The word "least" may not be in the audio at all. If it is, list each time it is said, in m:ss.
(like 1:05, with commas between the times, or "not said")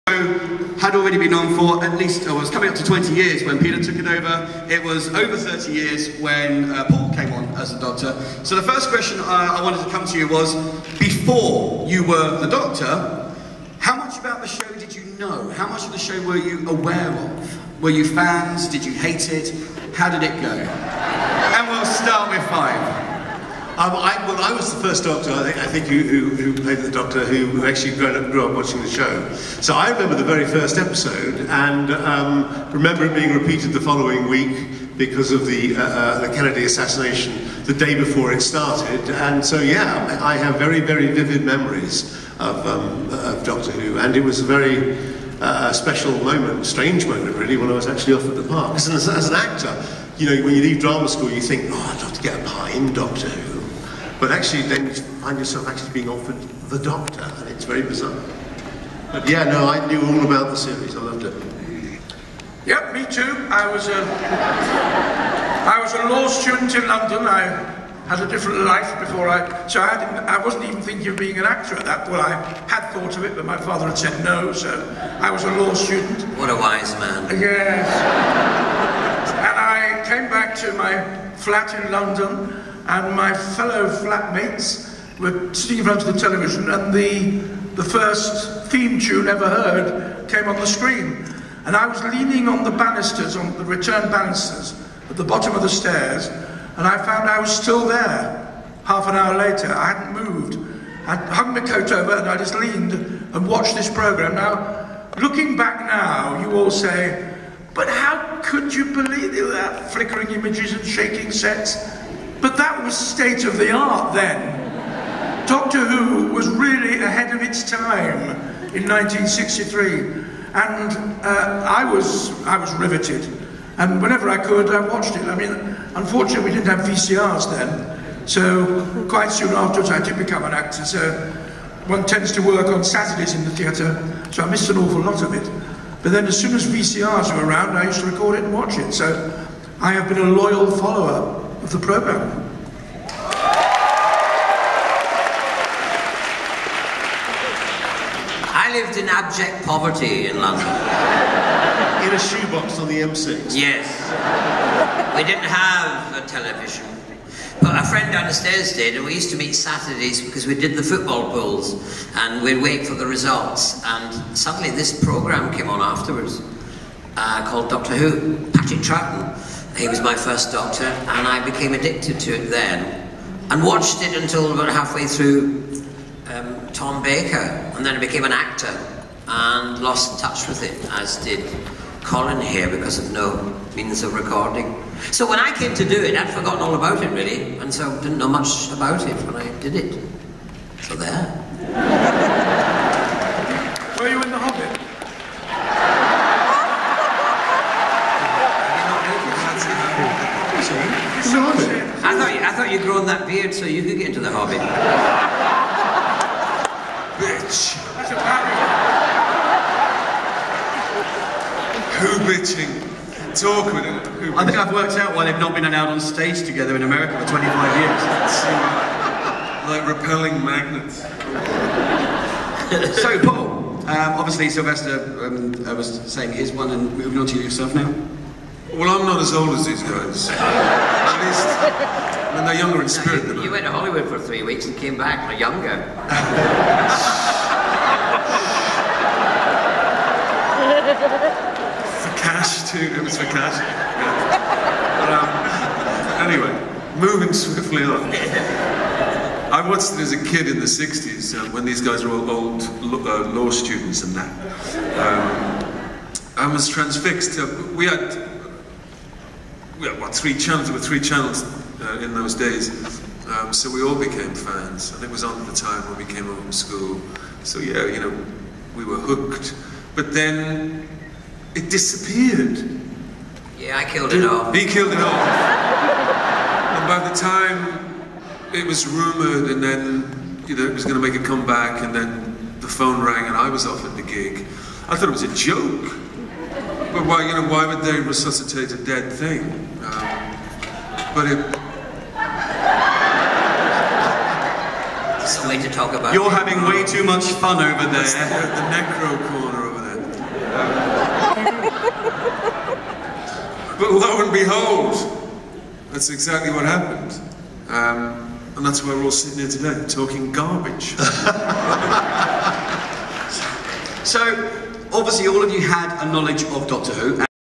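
0:01, 3:51.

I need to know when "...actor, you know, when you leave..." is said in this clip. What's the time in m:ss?
0:49.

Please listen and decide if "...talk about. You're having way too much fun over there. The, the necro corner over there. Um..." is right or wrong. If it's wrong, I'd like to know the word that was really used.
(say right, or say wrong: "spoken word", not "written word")
right.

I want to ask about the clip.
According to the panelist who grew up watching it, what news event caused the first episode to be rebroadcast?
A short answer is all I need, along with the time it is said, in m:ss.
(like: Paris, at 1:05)
Kennedy assassination, at 0:36.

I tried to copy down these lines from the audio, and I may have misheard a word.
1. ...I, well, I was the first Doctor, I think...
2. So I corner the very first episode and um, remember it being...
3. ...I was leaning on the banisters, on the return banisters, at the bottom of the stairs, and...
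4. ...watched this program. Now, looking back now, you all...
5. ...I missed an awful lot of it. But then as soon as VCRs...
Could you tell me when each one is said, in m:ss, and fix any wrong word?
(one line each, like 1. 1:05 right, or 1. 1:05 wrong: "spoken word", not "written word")
1. 0:23 right
2. 0:29 wrong: "remember", not "corner"
3. 1:31 right
4. 1:43 right
5. 2:14 right.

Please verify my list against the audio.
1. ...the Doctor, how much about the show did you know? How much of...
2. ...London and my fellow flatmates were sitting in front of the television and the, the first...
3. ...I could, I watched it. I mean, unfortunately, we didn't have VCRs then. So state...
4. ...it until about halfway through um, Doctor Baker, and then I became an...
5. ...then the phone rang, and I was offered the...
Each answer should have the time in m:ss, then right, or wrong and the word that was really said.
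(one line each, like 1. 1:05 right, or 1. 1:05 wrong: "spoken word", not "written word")
1. 0:12 right
2. 1:21 right
3. 2:04 wrong: "quite", not "state"
4. 2:54 wrong: "Tom", not "Doctor"
5. 4:41 right.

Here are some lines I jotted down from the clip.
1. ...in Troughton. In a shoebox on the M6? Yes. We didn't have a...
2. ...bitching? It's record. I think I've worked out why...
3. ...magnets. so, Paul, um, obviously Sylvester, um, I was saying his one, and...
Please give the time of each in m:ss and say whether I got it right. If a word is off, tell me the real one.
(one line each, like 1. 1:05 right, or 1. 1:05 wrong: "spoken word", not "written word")
1. 2:30 wrong: "London", not "Troughton"
2. 3:32 wrong: "awkward", not "record"
3. 3:40 right.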